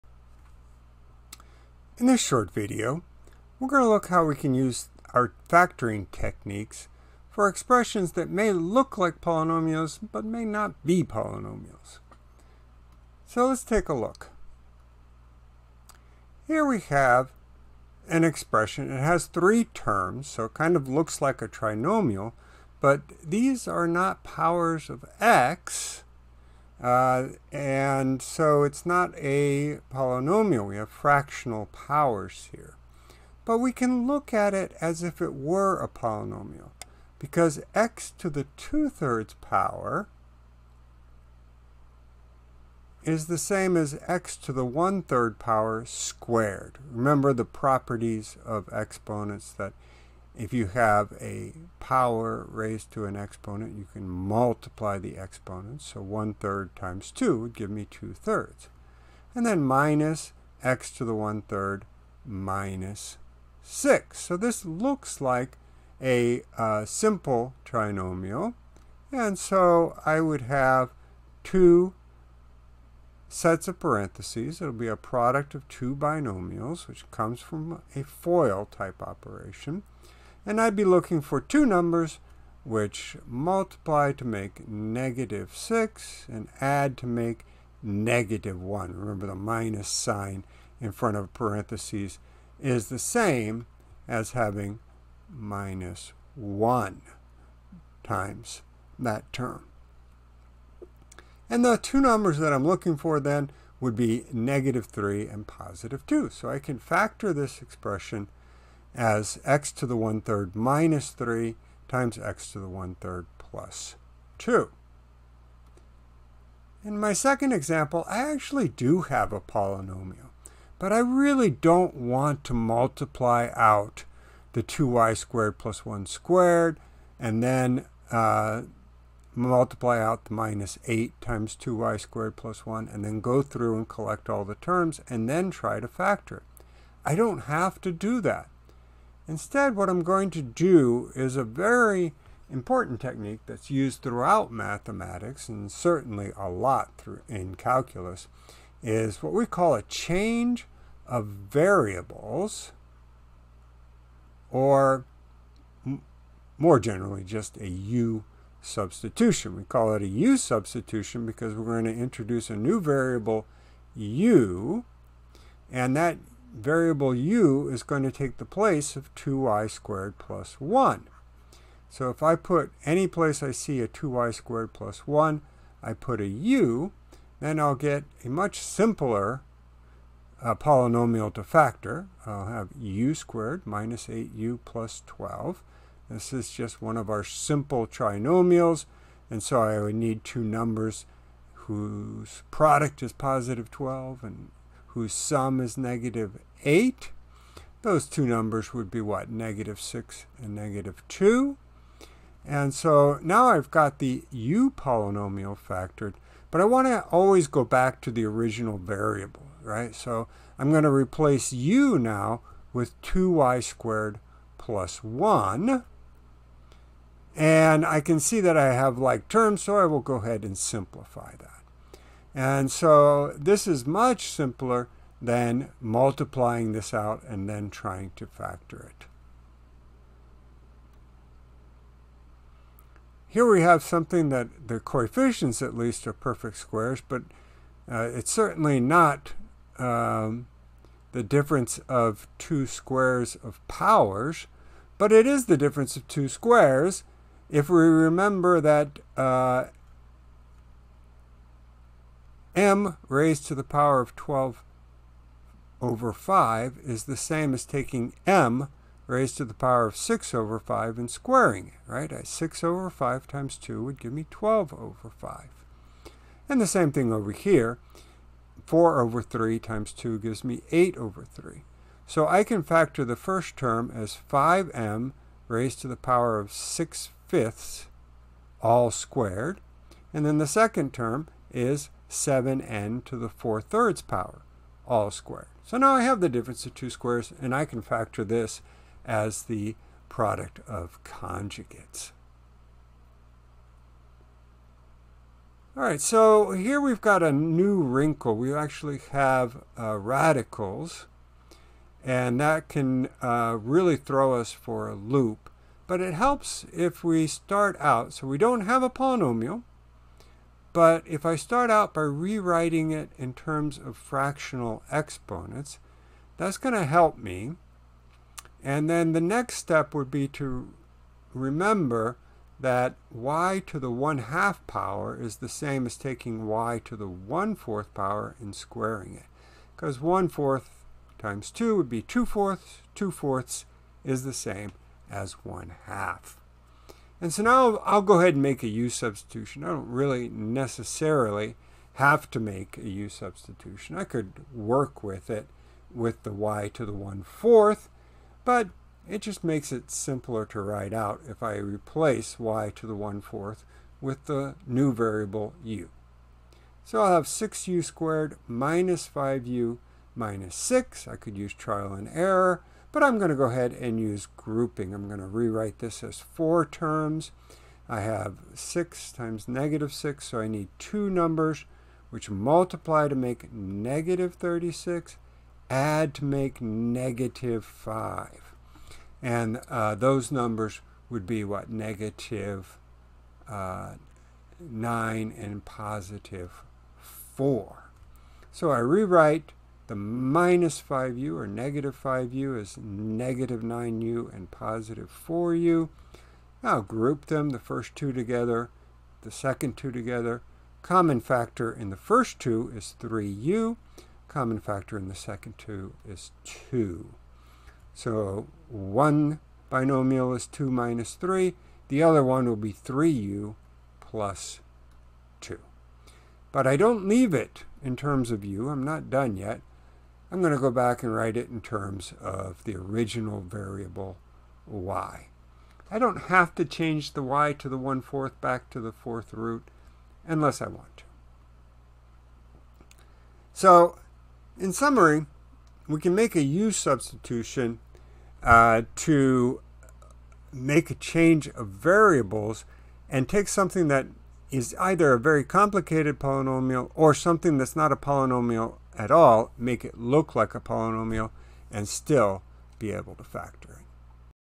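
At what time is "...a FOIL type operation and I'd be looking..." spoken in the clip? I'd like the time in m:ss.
1:17.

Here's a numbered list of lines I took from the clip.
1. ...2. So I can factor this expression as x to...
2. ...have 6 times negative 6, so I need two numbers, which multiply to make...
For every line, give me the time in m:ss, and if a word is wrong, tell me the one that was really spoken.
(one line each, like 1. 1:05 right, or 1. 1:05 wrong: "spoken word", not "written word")
1. 1:46 right
2. 6:08 right.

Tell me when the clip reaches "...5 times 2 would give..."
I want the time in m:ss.
4:22.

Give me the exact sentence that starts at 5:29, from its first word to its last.
Because 1 fourth times 2 would be 2 fourths.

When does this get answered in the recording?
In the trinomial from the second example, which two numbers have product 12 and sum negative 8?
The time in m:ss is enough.
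3:19.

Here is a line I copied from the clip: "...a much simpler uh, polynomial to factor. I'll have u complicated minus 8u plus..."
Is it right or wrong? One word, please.
wrong.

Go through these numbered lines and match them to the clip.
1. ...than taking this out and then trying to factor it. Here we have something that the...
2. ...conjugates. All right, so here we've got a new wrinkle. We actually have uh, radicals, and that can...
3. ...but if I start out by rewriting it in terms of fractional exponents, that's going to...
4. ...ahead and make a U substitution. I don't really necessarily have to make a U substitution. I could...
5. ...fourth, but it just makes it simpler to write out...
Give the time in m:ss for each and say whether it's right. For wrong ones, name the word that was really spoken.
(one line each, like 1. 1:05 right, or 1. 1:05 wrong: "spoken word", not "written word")
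1. 3:45 wrong: "multiplying", not "taking"
2. 4:51 right
3. 5:10 right
4. 5:38 right
5. 5:47 right.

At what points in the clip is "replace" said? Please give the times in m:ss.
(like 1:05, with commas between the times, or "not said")
3:30, 5:51.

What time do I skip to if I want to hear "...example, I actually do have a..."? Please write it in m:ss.
1:57.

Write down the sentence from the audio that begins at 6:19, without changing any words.
And uh, those numbers would be what?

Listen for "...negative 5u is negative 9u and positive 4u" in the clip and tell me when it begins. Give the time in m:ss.
6:31.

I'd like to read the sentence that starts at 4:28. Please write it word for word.
4 over 3 times 2 gives me 8 over 3.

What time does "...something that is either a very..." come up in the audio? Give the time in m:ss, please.
7:23.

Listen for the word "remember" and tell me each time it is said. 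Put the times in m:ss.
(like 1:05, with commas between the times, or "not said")
0:46, 1:28, 4:07, 5:21.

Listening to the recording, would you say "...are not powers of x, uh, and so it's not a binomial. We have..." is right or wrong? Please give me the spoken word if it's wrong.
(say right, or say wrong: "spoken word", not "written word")
wrong: "polynomial", not "binomial".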